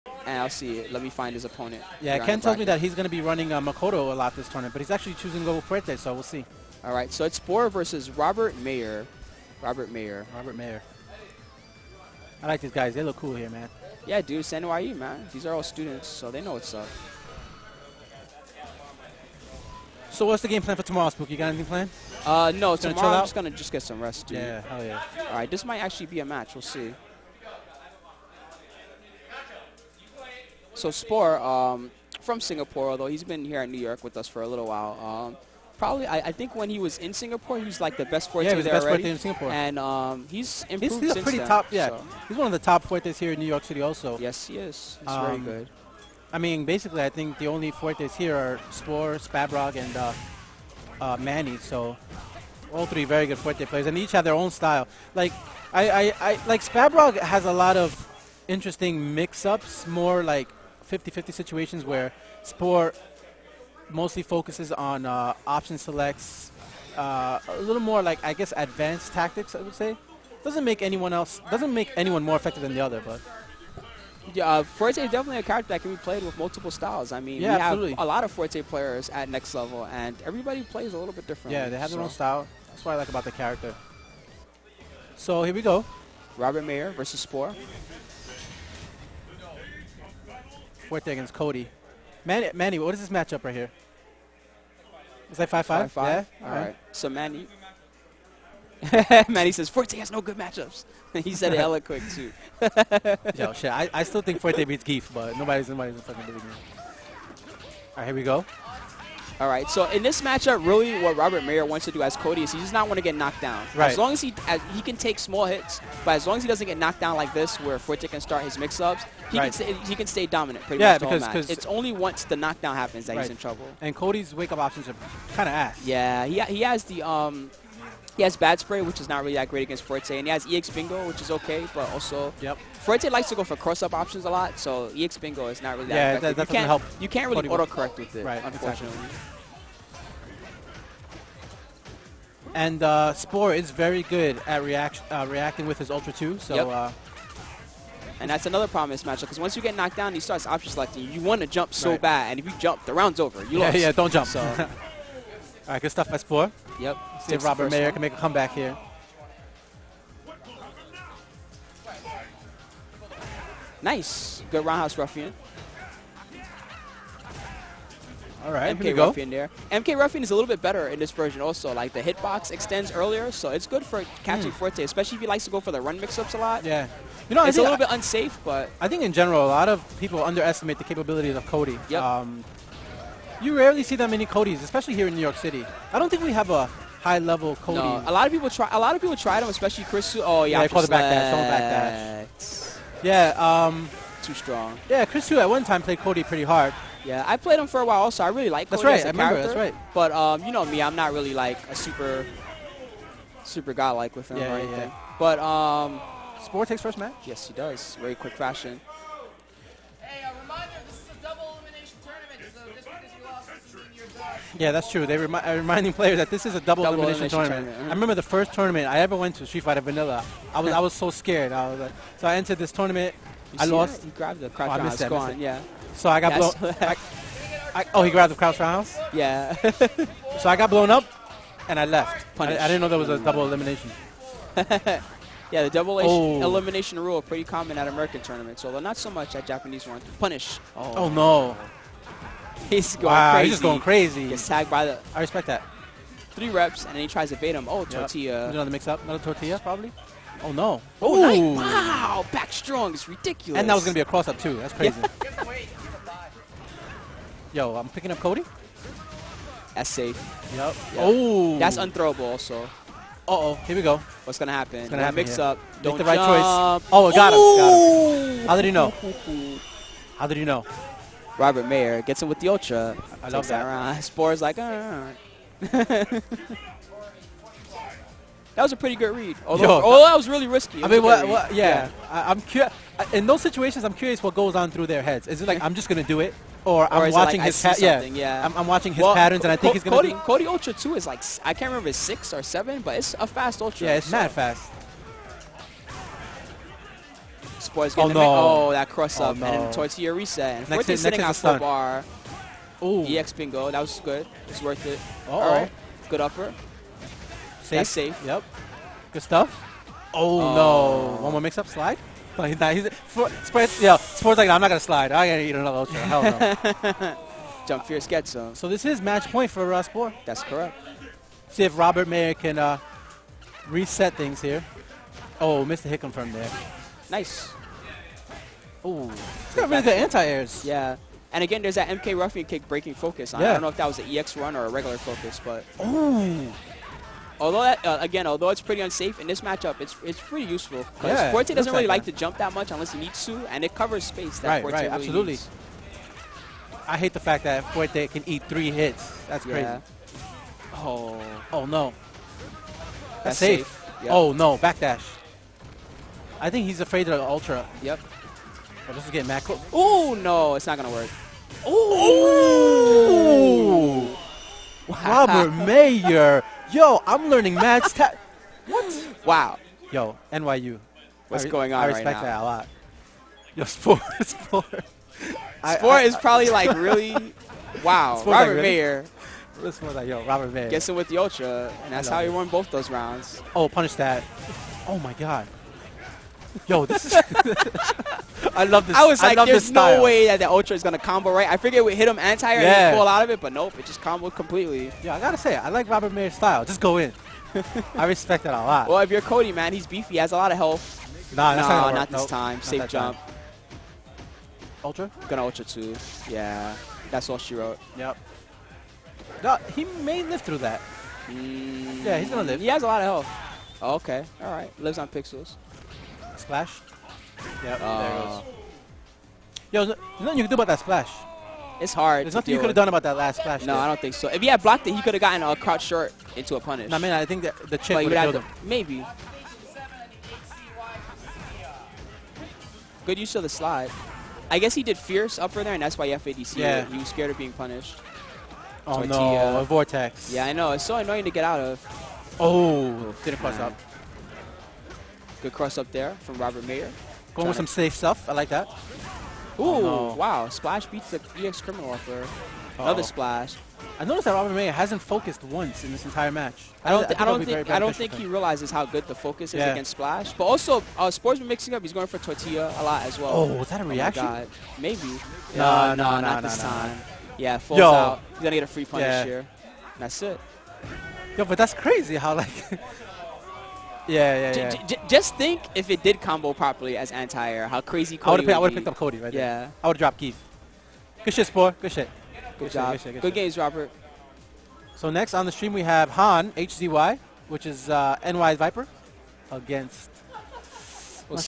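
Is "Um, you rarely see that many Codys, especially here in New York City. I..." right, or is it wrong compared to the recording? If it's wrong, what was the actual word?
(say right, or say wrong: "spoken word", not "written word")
right.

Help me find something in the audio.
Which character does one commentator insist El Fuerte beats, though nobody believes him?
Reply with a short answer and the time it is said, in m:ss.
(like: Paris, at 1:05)
Gief, at 1:44.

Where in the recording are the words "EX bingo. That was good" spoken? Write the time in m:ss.
5:03.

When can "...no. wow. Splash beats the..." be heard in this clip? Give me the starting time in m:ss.
7:30.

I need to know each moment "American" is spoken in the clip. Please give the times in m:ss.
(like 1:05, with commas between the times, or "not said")
3:57.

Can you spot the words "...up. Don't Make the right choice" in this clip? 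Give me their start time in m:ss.
4:25.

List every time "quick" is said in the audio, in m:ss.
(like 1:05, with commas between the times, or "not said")
1:41, 3:28.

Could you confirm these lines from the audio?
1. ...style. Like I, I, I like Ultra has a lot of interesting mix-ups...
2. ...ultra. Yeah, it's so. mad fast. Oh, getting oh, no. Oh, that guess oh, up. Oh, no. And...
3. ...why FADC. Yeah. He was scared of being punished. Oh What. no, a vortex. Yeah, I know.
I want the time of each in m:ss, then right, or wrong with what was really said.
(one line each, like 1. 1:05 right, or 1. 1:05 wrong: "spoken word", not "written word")
1. 0:54 wrong: "Spabrog", not "Ultra"
2. 4:53 wrong: "cross", not "guess"
3. 7:15 wrong: "Tortilla", not "What".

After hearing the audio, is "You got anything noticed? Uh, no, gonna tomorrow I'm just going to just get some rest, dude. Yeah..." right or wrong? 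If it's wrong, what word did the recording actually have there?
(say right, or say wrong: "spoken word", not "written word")
wrong: "planned", not "noticed".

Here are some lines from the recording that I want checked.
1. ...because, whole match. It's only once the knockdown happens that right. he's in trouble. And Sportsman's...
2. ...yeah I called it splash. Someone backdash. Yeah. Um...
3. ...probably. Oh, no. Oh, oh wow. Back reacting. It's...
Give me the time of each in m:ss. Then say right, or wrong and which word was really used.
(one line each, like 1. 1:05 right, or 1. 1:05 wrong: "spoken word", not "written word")
1. 2:01 wrong: "Cody", not "Sportsman"
2. 3:10 wrong: "backdash", not "splash"
3. 4:09 wrong: "strong", not "reacting".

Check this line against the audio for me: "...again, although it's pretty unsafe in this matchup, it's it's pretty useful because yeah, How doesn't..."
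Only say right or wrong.
wrong.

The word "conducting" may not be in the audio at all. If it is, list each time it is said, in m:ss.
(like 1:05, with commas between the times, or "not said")
not said.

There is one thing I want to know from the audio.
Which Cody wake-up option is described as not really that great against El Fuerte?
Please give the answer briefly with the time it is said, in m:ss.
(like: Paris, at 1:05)
Bad Spray, at 2:08.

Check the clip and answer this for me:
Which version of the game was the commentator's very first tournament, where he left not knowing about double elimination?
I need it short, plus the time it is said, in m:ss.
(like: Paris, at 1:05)
Street Fighter Vanilla, at 3:39.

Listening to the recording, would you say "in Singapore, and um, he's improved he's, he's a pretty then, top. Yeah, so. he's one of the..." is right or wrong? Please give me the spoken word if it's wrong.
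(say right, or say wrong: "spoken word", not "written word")
right.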